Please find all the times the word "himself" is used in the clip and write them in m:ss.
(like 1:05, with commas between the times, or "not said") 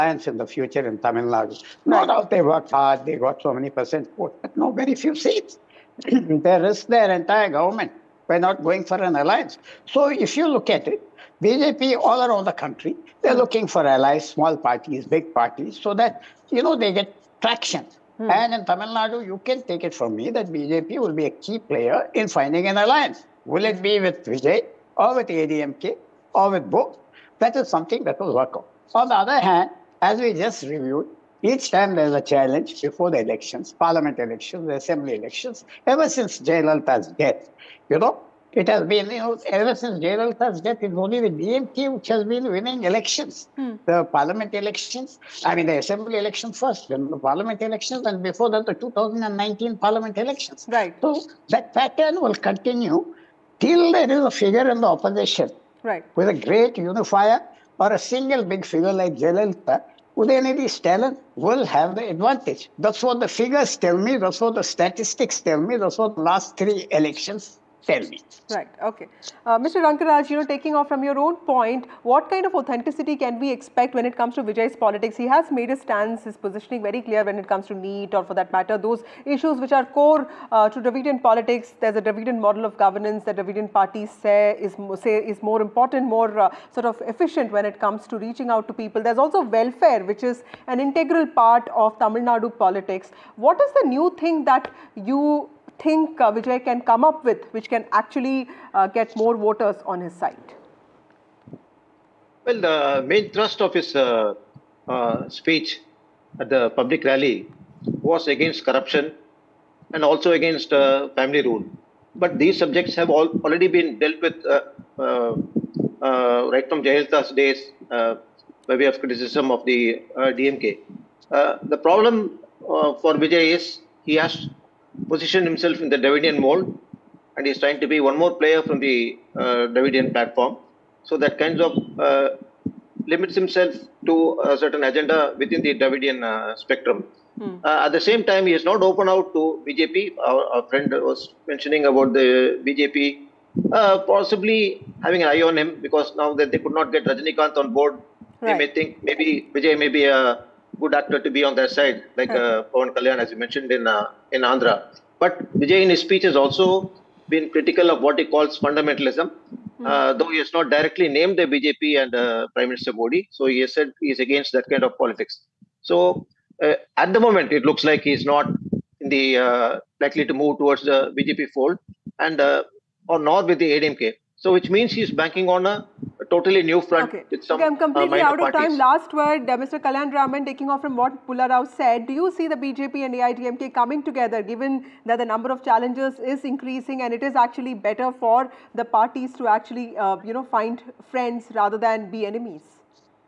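2:05, 2:13.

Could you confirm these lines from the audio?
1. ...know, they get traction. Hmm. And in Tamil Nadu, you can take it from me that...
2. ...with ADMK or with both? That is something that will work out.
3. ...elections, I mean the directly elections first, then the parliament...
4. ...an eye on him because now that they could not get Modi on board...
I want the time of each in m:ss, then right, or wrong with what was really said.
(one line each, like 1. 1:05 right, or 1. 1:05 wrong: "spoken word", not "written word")
1. 0:16 right
2. 0:25 right
3. 0:44 wrong: "assembly", not "directly"
4. 2:25 wrong: "Rajinikanth", not "Modi".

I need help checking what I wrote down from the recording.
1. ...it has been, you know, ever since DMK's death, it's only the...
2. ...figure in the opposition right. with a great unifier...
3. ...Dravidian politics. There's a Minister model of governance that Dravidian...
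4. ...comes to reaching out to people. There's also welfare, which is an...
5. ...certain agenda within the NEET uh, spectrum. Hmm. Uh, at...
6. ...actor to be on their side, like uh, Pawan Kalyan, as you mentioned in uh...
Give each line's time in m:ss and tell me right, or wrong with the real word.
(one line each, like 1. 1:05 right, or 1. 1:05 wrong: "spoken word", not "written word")
1. 0:38 wrong: "Jayalalitha", not "DMK"
2. 0:54 right
3. 1:20 wrong: "Dravidian", not "Minister"
4. 1:27 right
5. 2:14 wrong: "Dravidian", not "NEET"
6. 2:31 right.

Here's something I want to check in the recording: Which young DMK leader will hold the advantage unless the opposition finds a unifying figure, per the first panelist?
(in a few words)
Udayanidhi.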